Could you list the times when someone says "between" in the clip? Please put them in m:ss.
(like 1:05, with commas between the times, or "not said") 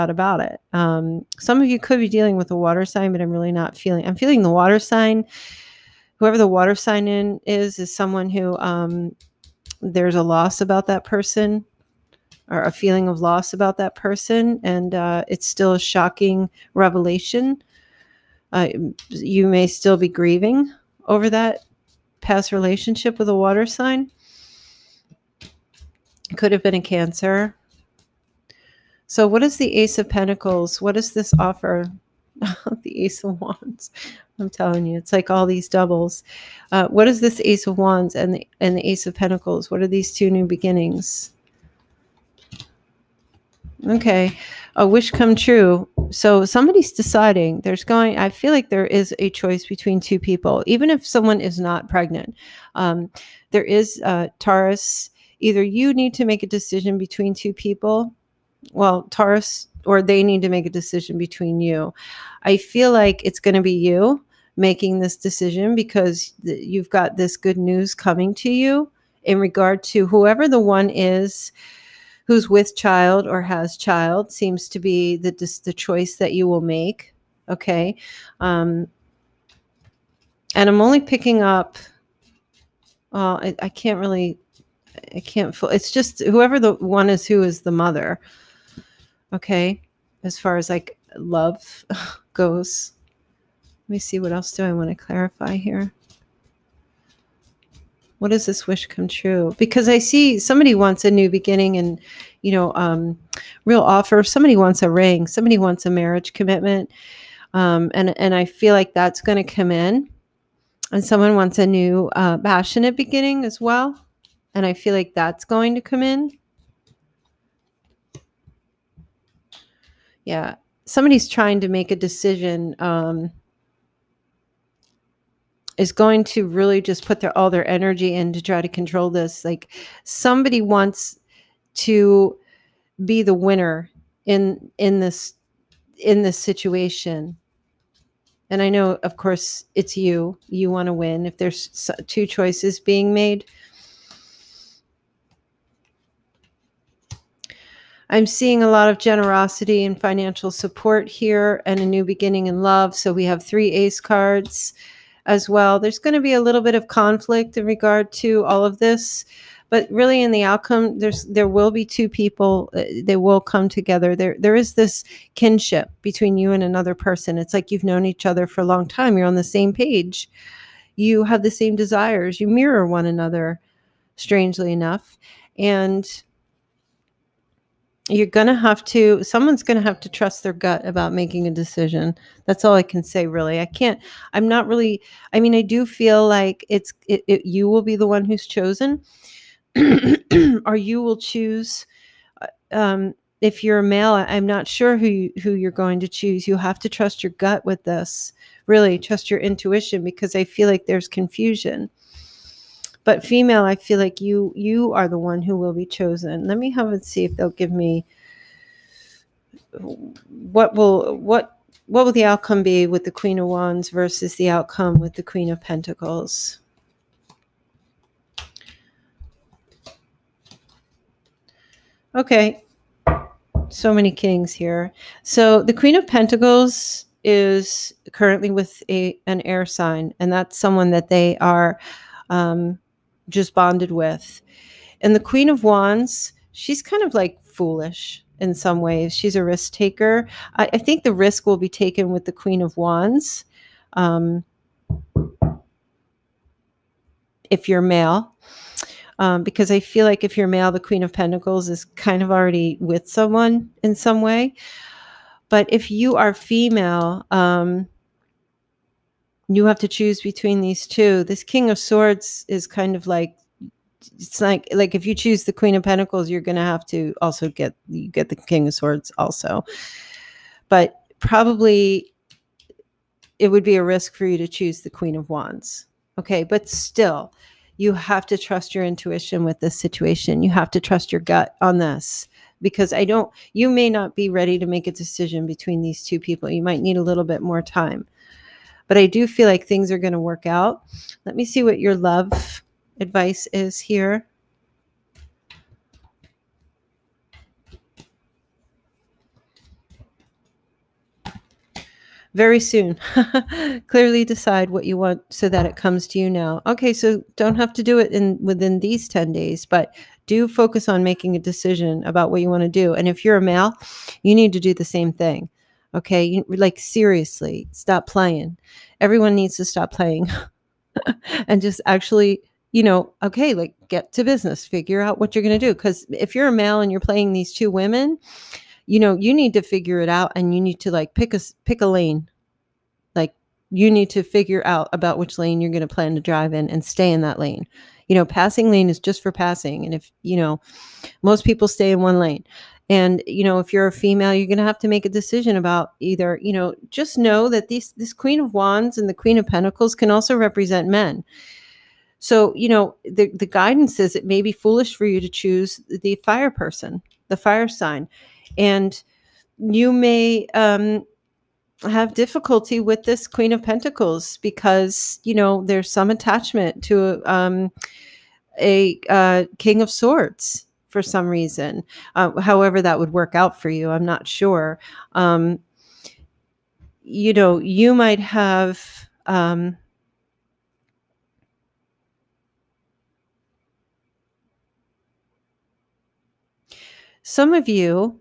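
0:49, 0:56, 1:01, 2:46, 4:20, 4:45.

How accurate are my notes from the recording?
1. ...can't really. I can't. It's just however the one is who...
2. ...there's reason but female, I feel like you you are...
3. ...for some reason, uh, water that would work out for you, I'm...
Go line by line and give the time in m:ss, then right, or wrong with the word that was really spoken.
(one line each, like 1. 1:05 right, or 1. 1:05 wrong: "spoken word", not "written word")
1. 1:23 wrong: "whoever", not "however"
2. 3:20 wrong: "confusion", not "reason"
3. 6:10 wrong: "however", not "water".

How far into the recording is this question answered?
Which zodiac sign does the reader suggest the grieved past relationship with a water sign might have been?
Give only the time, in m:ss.
0:26.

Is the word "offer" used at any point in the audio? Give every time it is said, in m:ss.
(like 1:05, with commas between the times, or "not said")
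0:31, 1:43.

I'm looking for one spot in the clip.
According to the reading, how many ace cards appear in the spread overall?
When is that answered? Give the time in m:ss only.
2:33.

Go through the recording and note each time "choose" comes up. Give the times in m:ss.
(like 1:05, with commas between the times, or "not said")
3:11, 3:16, 4:19, 4:25, 4:34, 5:55.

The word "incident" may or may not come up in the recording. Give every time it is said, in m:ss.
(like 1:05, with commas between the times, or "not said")
not said.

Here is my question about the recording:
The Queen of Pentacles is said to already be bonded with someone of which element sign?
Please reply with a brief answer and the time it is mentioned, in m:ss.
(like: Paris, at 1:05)
air, at 3:49.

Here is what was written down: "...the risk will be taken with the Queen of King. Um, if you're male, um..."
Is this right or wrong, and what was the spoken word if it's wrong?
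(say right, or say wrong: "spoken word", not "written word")
wrong: "Wands", not "King".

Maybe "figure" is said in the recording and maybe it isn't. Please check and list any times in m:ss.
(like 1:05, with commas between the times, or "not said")
5:24, 5:29, 5:34.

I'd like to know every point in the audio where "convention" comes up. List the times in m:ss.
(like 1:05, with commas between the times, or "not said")
not said.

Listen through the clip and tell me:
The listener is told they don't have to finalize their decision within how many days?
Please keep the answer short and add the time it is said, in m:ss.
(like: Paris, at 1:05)
10, at 5:09.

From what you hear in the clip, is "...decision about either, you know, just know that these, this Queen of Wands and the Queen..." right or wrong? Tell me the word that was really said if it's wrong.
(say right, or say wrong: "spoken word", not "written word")
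right.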